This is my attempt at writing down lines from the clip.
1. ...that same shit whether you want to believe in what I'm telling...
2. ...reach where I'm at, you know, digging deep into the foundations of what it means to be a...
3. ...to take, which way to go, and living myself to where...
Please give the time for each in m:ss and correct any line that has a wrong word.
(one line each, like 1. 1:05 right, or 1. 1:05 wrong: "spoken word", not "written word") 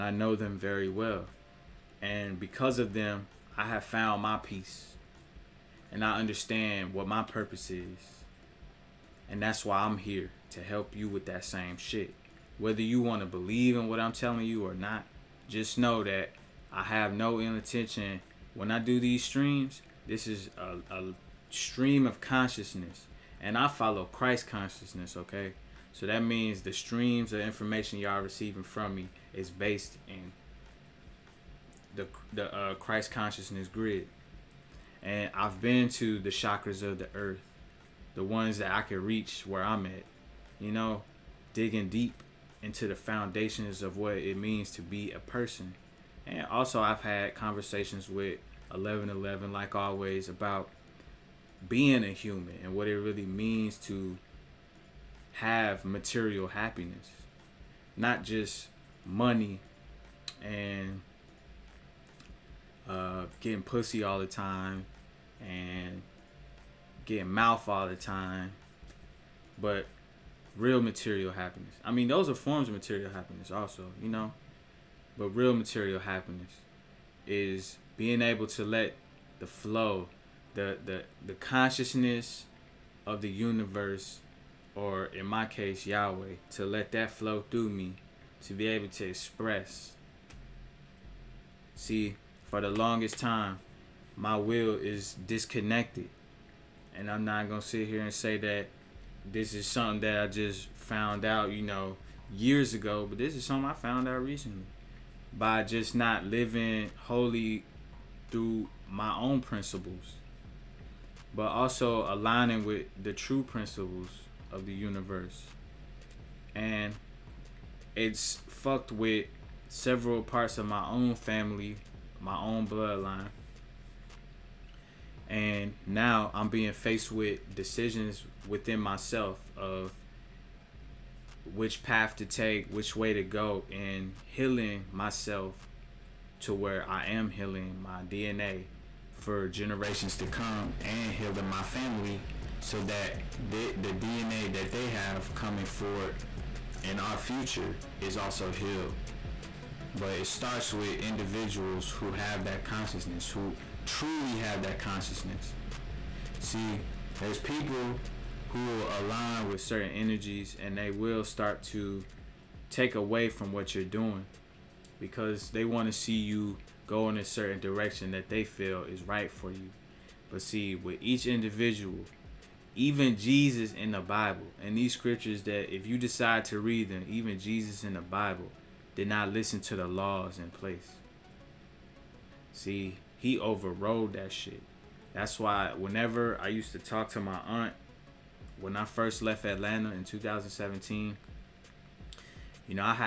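1. 0:11 right
2. 0:39 right
3. 2:12 wrong: "healing", not "living".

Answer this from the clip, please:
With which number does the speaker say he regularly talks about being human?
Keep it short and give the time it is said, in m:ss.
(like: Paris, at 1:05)
1111, at 0:48.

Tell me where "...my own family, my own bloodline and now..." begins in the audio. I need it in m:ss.
2:00.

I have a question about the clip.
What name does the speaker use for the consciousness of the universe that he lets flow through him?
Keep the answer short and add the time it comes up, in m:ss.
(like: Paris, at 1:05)
Yahweh, at 1:25.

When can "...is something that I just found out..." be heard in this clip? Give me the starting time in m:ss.
1:39.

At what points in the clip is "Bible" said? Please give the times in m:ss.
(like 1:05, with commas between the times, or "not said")
2:54, 2:58.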